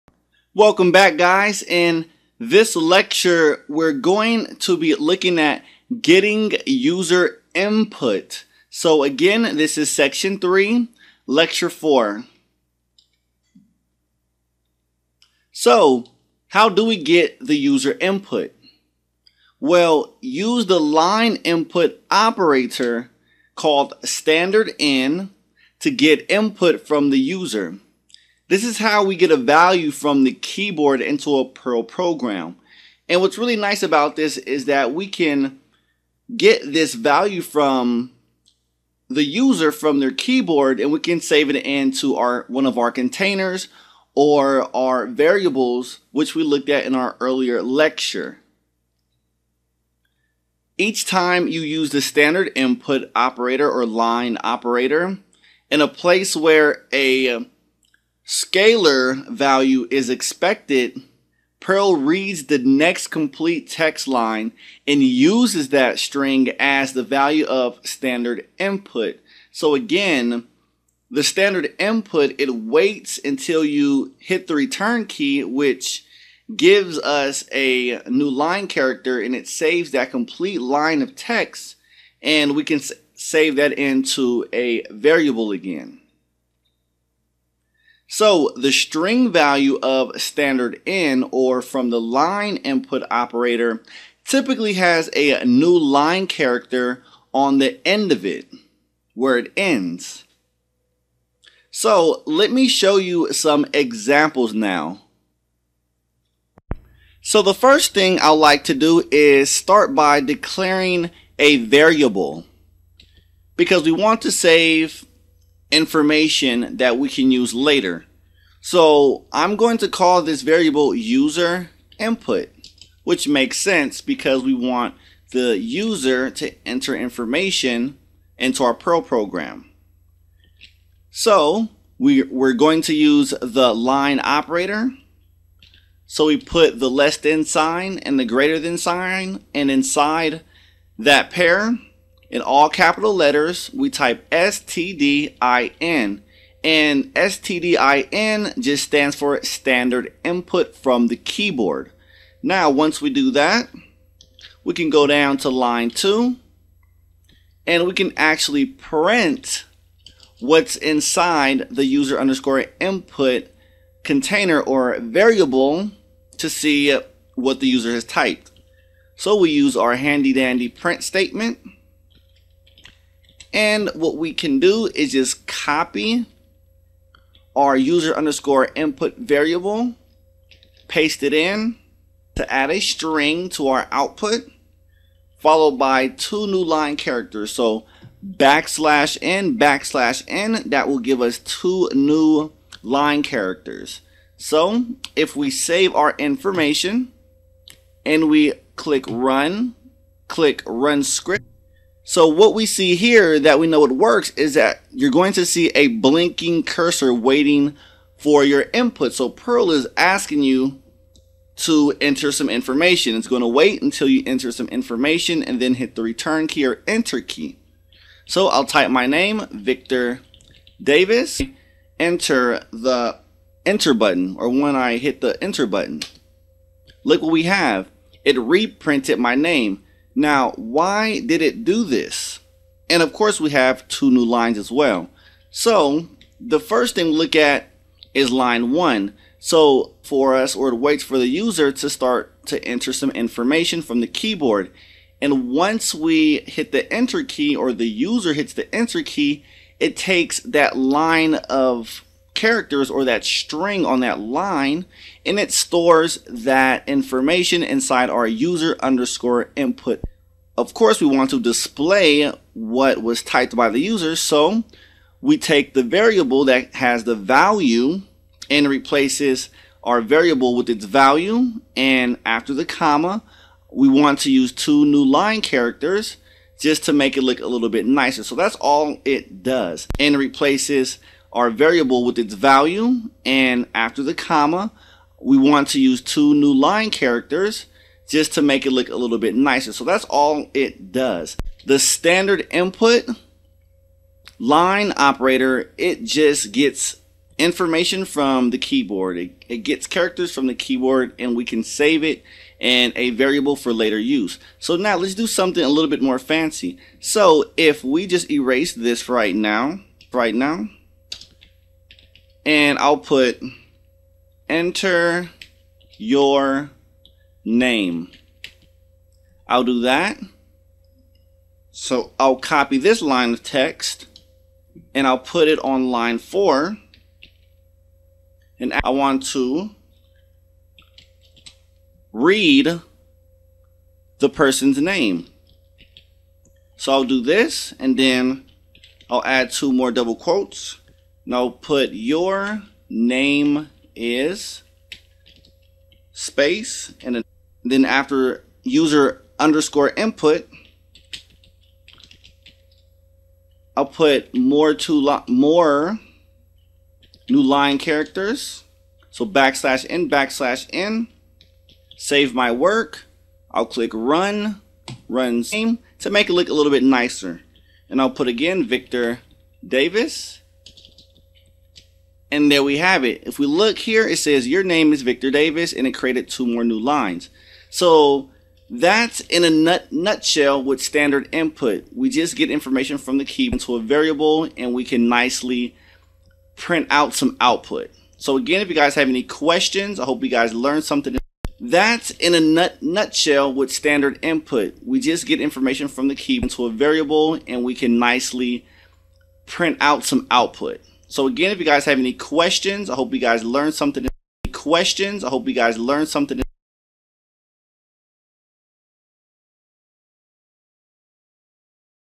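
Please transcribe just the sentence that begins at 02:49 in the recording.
So we use our handy dandy print statement.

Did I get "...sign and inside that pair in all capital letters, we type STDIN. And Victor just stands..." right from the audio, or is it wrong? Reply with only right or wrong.
wrong.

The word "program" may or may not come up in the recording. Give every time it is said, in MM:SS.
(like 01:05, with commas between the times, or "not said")
00:31, 02:09.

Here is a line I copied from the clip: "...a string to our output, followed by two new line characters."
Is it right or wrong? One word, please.
right.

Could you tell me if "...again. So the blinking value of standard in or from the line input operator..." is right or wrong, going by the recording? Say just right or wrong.
wrong.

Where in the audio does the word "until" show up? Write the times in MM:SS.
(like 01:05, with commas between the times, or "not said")
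01:13, 03:33.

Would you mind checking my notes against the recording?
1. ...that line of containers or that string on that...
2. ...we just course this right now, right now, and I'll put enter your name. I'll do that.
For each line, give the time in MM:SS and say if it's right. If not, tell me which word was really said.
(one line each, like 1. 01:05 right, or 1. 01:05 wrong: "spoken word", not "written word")
1. 04:10 wrong: "characters", not "containers"
2. 05:07 wrong: "erase", not "course".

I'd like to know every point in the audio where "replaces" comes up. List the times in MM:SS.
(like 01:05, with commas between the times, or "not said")
04:28, 04:40.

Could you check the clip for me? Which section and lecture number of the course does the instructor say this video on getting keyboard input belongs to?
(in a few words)
Section 3, lecture 4.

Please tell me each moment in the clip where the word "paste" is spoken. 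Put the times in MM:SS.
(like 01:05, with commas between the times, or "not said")
03:00.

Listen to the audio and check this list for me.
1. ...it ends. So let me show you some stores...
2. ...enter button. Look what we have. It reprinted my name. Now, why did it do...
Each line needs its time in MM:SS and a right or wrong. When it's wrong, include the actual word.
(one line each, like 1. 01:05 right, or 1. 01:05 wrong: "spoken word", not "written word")
1. 01:39 wrong: "examples", not "stores"
2. 03:45 right.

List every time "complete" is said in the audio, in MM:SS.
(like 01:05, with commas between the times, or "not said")
01:03, 01:20.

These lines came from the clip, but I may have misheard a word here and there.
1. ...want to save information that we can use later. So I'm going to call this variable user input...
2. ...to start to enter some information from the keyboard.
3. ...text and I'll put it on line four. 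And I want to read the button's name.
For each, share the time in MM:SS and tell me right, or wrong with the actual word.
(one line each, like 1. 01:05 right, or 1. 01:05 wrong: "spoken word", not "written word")
1. 01:53 right
2. 04:01 right
3. 05:23 wrong: "person", not "button".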